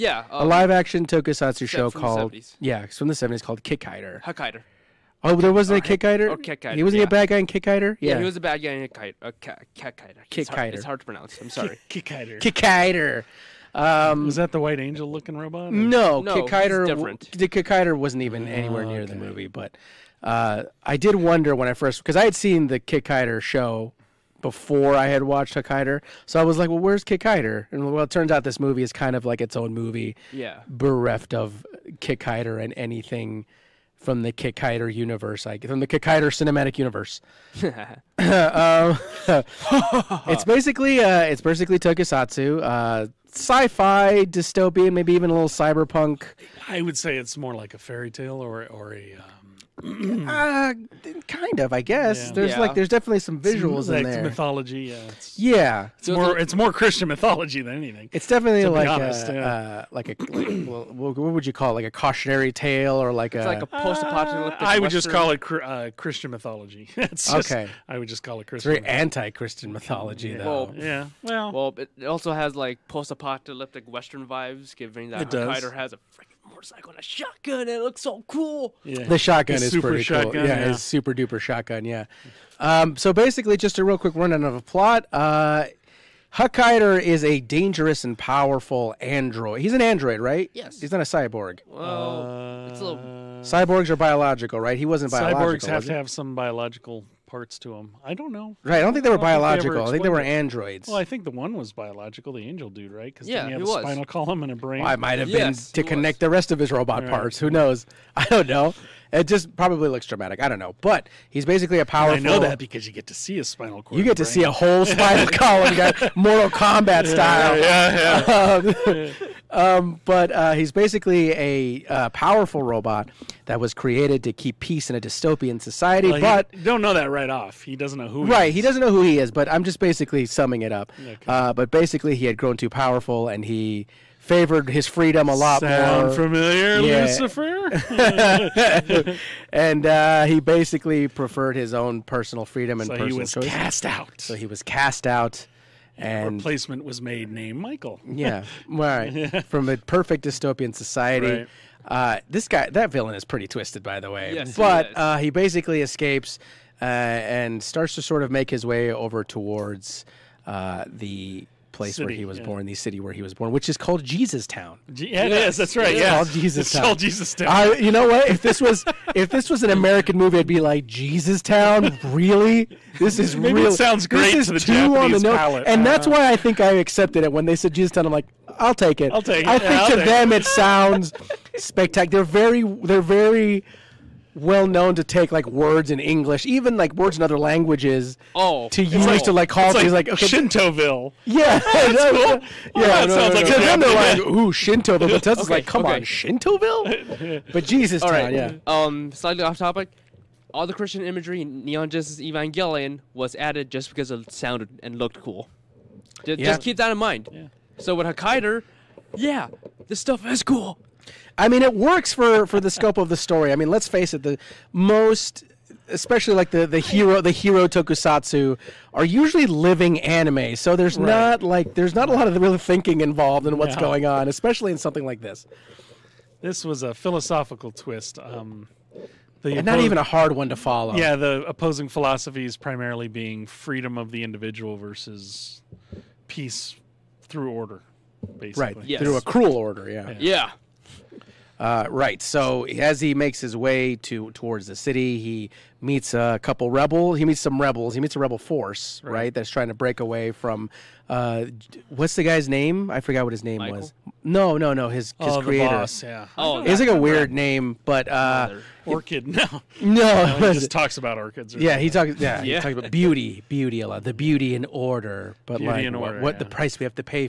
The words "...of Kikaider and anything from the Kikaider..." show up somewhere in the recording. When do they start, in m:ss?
0:31.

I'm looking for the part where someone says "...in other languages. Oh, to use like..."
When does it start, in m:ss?
3:07.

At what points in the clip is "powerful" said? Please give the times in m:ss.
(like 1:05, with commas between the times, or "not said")
1:28, 1:51, 2:02, 2:12.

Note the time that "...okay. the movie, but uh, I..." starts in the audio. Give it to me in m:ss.
0:19.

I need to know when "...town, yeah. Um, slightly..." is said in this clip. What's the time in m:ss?
3:18.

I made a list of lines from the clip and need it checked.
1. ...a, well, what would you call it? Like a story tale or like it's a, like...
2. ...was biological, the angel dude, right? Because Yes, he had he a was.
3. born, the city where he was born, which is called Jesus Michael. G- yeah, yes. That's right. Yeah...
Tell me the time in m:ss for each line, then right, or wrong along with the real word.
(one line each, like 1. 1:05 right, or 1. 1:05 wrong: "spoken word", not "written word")
1. 1:00 wrong: "cautionary", not "story"
2. 1:41 wrong: "Yeah", not "Yes"
3. 2:42 wrong: "Town", not "Michael".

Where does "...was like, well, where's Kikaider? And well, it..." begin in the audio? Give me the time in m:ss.
0:26.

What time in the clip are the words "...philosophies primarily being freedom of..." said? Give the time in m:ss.
3:51.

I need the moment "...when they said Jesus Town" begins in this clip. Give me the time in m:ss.
2:57.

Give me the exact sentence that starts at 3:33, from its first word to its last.
I mean, let's face it, the most especially like the the hero the hero tokusatsu are usually living anime so there's right.